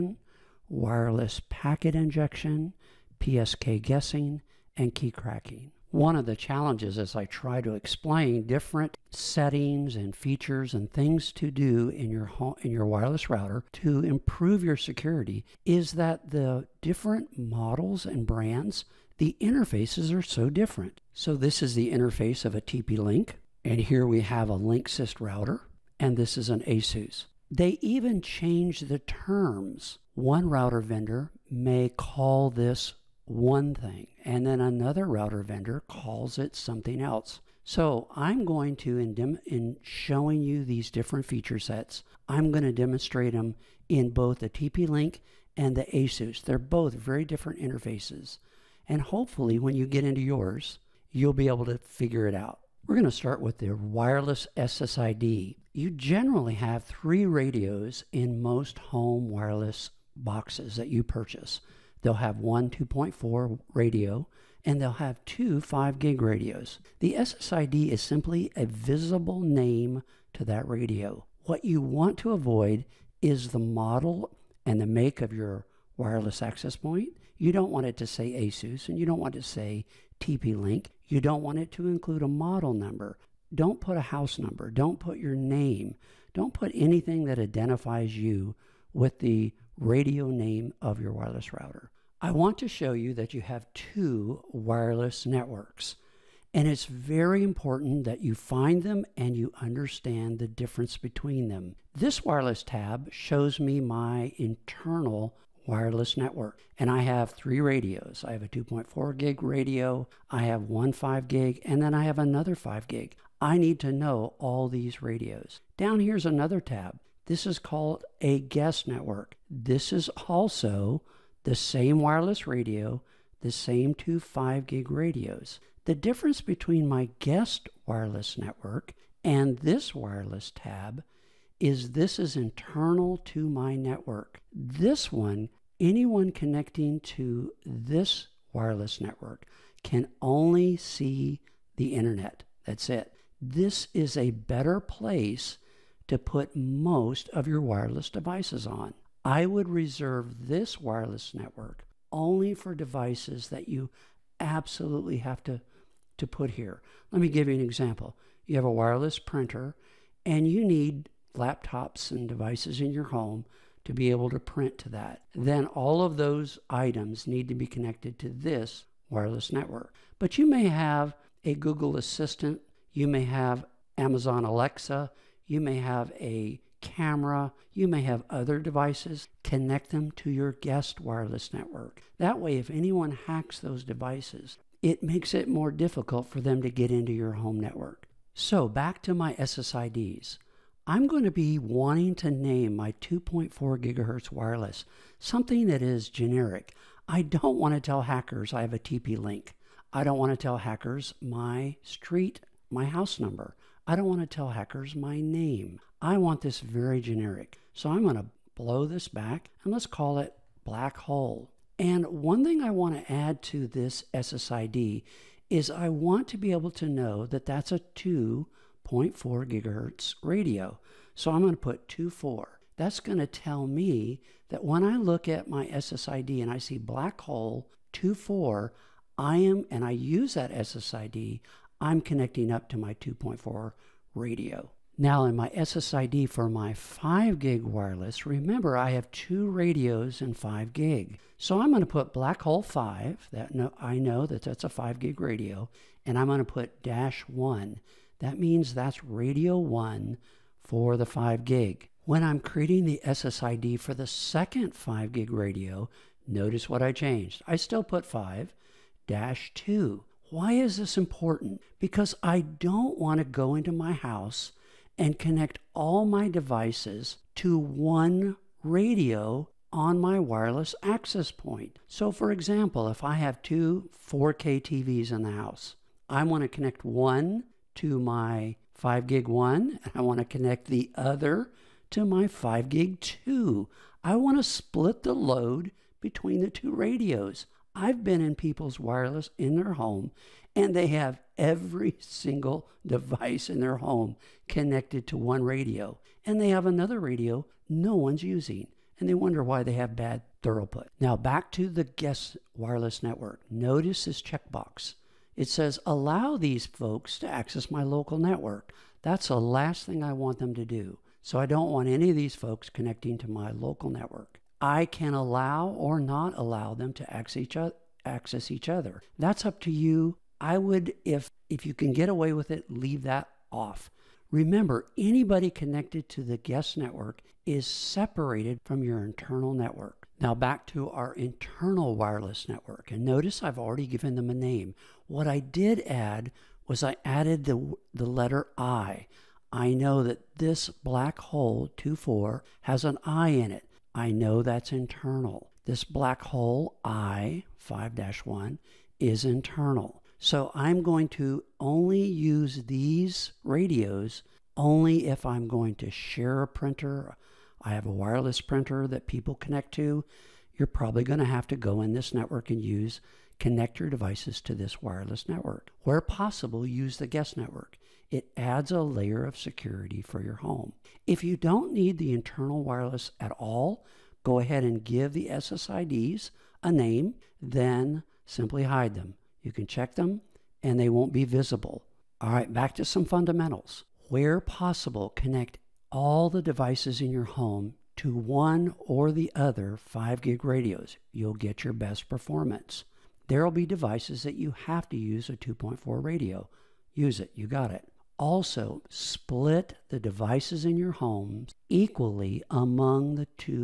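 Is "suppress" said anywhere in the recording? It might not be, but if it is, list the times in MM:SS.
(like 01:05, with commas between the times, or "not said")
not said.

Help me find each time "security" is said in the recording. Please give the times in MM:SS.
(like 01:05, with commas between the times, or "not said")
00:14, 06:09.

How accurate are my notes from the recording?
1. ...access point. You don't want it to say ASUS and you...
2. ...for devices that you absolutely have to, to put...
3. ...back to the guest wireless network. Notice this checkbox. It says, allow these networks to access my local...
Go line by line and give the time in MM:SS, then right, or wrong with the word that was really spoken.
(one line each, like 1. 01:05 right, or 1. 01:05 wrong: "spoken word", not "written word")
1. 01:16 right
2. 02:32 right
3. 05:01 wrong: "folks", not "networks".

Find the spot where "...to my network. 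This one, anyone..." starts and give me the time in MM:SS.
02:13.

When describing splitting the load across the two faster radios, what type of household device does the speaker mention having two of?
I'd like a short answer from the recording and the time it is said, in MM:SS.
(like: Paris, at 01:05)
4K TVs, at 04:34.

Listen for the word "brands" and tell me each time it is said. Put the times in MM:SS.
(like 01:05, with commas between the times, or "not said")
00:18.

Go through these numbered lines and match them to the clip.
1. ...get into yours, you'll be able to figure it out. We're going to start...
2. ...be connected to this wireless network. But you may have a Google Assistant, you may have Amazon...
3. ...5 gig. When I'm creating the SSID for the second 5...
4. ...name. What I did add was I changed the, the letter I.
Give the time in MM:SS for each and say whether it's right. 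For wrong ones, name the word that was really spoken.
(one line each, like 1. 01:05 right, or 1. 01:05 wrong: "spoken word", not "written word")
1. 00:49 right
2. 02:47 right
3. 04:11 right
4. 05:34 wrong: "added", not "changed".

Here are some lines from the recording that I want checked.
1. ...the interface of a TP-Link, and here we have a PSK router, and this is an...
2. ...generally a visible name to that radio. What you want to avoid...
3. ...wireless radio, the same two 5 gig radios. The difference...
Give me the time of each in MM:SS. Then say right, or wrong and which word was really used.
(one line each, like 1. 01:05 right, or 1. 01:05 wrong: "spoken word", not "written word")
1. 00:21 wrong: "Linksys", not "PSK"
2. 01:08 wrong: "simply", not "generally"
3. 02:01 right.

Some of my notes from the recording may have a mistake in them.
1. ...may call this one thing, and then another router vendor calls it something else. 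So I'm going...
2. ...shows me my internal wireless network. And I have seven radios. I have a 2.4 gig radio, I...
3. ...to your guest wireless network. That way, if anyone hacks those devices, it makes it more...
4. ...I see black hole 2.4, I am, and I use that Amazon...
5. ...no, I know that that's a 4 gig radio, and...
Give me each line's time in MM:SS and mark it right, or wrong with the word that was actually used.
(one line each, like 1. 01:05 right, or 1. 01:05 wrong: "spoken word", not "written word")
1. 00:31 right
2. 01:43 wrong: "three", not "seven"
3. 03:00 right
4. 03:46 wrong: "SSID", not "Amazon"
5. 04:03 wrong: "5", not "4".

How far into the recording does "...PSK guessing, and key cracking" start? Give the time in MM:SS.
00:03.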